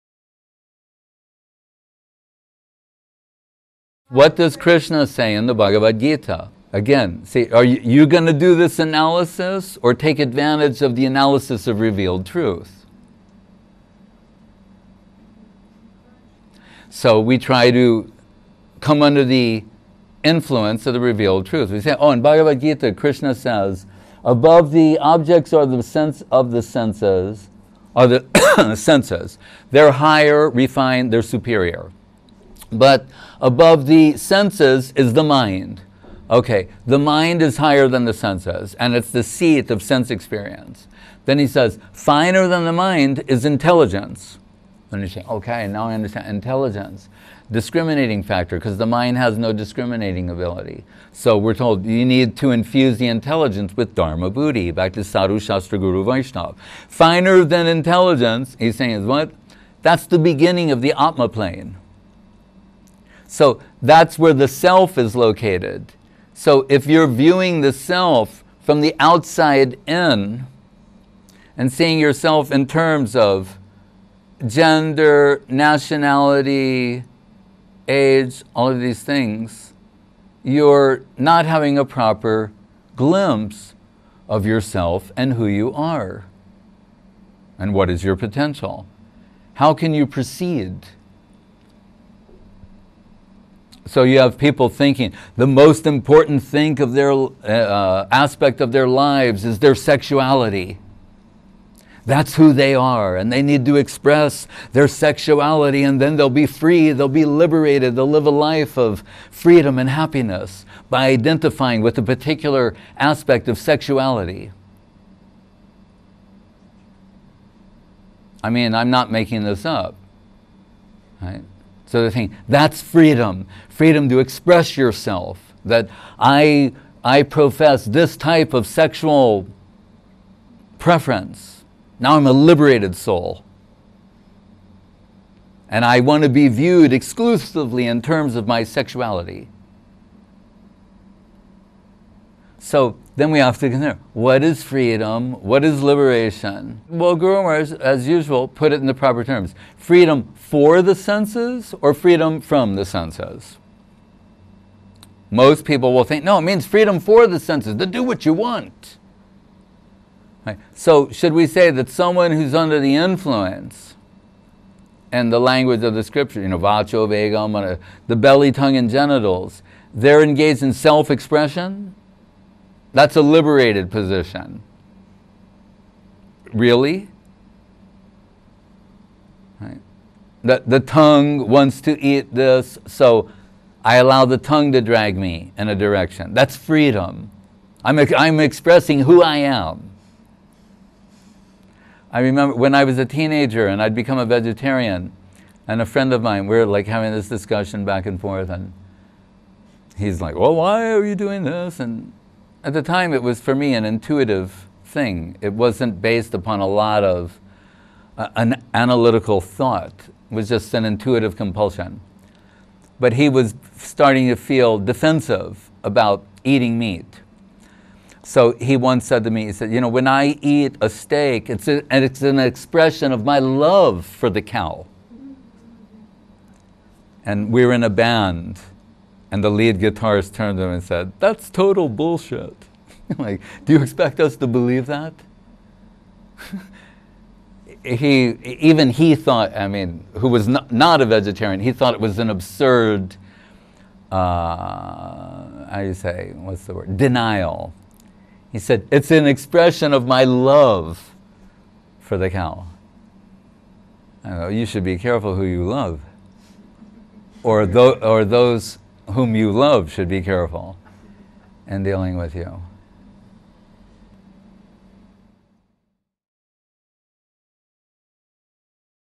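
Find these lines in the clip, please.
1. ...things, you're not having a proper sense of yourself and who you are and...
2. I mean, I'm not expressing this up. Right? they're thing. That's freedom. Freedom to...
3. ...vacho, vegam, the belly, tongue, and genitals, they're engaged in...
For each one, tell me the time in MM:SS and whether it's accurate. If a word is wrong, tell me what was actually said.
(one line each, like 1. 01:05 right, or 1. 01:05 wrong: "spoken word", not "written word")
1. 01:19 wrong: "glimpse", not "sense"
2. 01:58 wrong: "making", not "expressing"
3. 02:46 right.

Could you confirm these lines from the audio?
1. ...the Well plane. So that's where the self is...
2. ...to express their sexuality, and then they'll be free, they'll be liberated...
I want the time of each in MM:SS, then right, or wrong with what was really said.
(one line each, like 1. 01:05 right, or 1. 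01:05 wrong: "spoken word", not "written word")
1. 01:00 wrong: "Atma", not "Well"
2. 01:43 right.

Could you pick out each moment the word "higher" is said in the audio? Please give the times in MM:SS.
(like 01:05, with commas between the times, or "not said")
00:29, 00:37.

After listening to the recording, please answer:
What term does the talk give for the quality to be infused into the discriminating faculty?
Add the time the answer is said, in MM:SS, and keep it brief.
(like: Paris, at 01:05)
Dharma Buddhi, at 00:53.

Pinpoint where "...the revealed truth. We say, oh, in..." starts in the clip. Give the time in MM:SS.
00:20.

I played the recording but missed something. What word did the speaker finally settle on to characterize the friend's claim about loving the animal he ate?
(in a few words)
Denial.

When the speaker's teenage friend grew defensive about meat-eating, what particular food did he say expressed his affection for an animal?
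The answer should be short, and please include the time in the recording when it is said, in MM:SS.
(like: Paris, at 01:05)
steak, at 03:40.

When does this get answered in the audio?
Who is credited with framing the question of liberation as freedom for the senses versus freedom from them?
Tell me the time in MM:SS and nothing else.
02:27.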